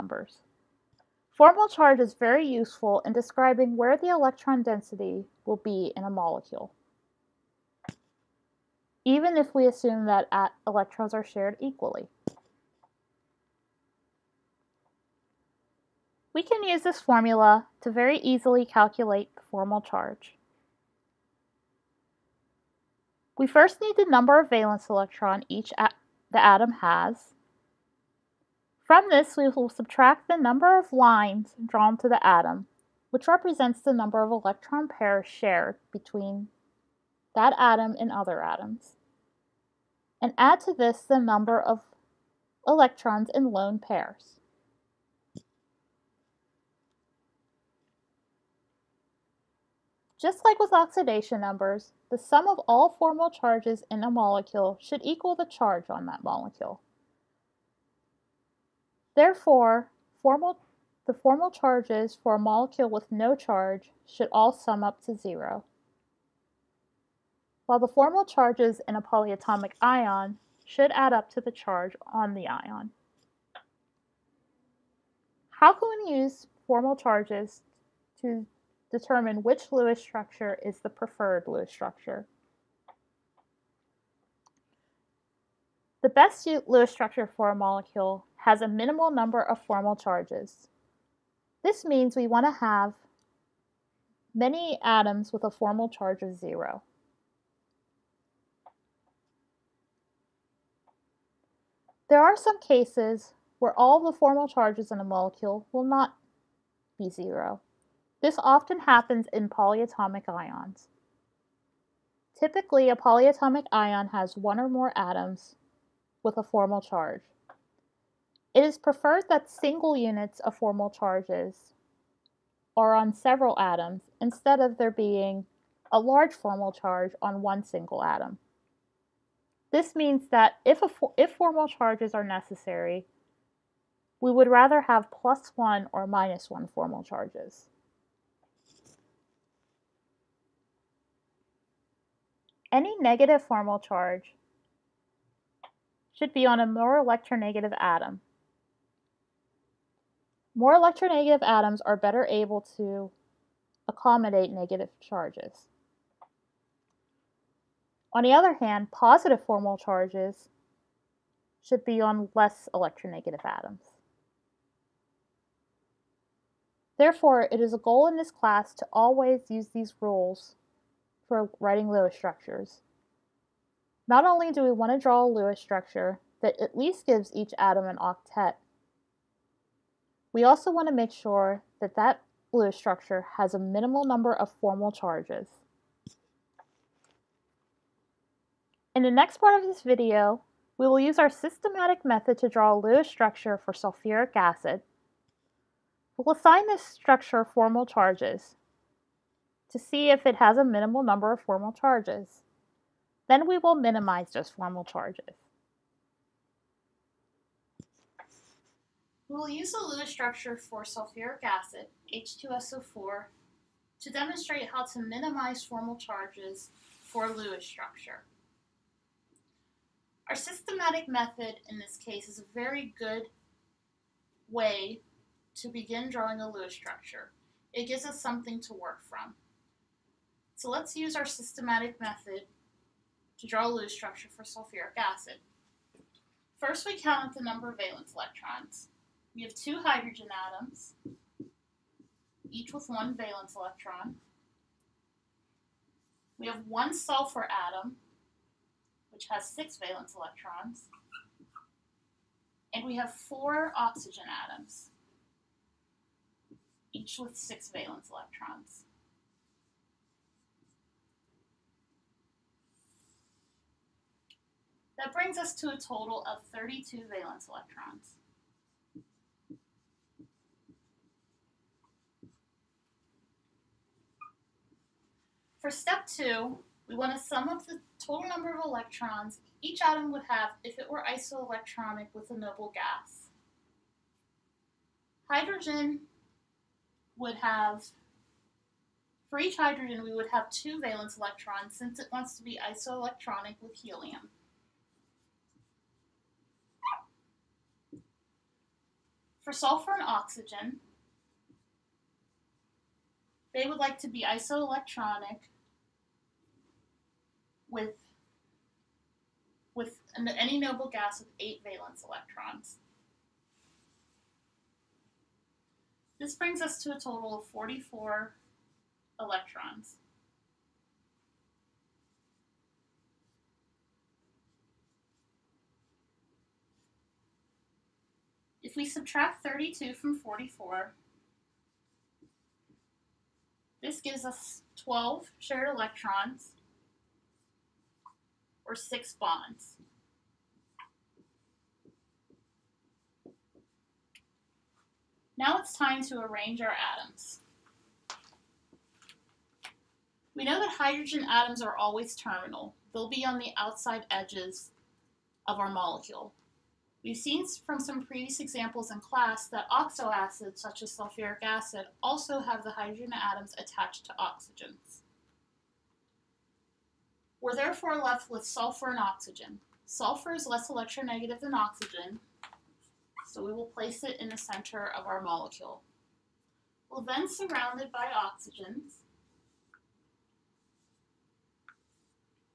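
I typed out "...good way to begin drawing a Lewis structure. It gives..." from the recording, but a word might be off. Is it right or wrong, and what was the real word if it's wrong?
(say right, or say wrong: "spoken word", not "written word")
right.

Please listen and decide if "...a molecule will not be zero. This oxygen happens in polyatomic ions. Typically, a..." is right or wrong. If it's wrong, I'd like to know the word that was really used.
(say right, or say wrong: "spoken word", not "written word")
wrong: "often", not "oxygen".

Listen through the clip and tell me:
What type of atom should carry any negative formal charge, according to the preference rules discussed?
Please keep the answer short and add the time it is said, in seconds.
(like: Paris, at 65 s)
More electronegative atom, at 146 s.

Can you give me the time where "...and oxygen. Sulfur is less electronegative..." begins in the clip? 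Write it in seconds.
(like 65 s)
368 s.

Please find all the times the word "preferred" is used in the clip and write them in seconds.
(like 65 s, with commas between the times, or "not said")
80 s, 118 s.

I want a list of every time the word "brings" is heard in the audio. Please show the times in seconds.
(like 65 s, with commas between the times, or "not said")
265 s, 316 s.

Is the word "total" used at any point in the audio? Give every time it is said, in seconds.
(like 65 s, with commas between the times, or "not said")
265 s, 278 s, 316 s.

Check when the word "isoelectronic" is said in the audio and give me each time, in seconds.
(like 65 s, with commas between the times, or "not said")
281 s, 292 s, 304 s.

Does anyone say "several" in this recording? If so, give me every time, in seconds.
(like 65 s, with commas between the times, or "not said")
123 s.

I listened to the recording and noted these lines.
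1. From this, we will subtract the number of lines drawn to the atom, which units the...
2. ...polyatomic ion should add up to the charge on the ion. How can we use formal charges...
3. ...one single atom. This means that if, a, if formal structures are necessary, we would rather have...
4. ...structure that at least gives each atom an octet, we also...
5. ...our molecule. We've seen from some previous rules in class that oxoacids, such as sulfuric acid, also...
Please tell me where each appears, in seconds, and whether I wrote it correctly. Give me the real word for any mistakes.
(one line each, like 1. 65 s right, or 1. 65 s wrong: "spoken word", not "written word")
1. 28 s wrong: "represents", not "units"
2. 69 s right
3. 127 s wrong: "charges", not "structures"
4. 175 s right
5. 355 s wrong: "examples", not "rules".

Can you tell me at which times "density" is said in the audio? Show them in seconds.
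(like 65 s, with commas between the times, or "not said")
4 s.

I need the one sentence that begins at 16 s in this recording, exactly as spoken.
We can use this formula to very easily calculate the formal charge.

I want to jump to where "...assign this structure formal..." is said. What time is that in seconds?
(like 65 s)
196 s.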